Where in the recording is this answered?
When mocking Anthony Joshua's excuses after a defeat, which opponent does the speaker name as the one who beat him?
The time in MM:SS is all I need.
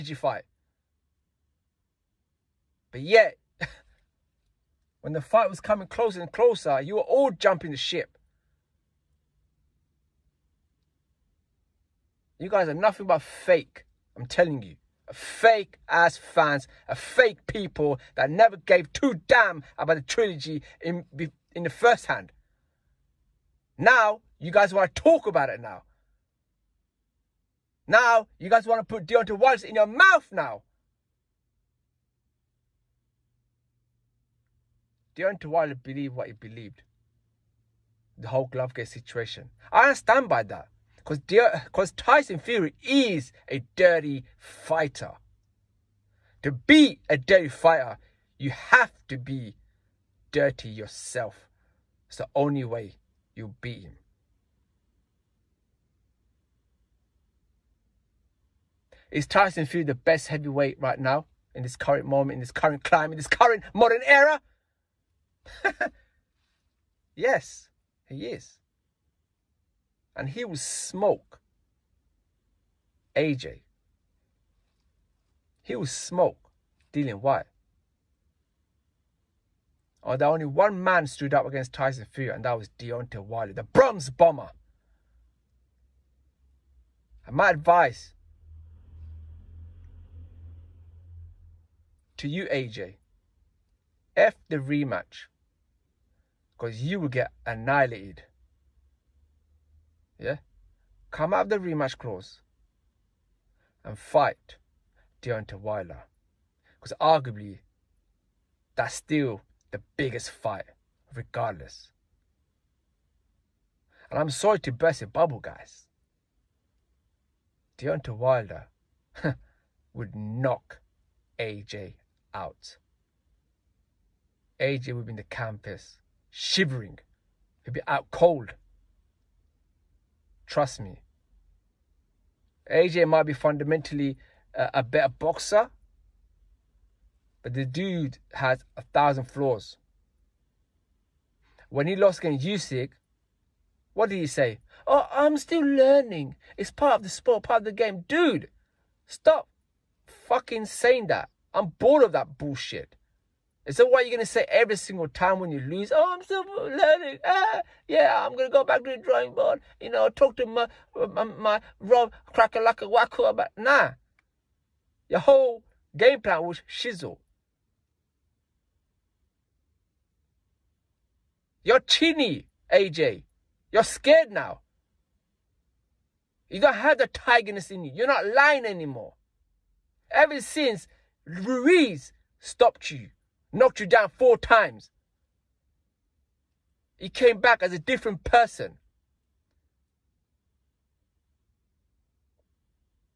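02:22.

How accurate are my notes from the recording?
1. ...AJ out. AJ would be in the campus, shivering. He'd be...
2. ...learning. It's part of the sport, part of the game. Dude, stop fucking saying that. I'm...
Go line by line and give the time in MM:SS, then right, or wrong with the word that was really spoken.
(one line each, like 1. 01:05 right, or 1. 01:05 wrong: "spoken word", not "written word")
1. 02:01 right
2. 02:25 right.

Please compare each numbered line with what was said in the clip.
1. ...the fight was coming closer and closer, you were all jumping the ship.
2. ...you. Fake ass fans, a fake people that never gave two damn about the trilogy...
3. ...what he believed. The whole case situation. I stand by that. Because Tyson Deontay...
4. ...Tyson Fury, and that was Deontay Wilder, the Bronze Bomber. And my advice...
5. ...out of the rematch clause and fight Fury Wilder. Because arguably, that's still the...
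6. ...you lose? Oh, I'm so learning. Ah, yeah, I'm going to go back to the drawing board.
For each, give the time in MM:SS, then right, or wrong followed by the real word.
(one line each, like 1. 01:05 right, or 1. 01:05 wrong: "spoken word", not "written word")
1. 00:05 right
2. 00:14 right
3. 00:36 wrong: "Fury", not "Deontay"
4. 01:21 right
5. 01:41 wrong: "Deontay", not "Fury"
6. 02:35 right.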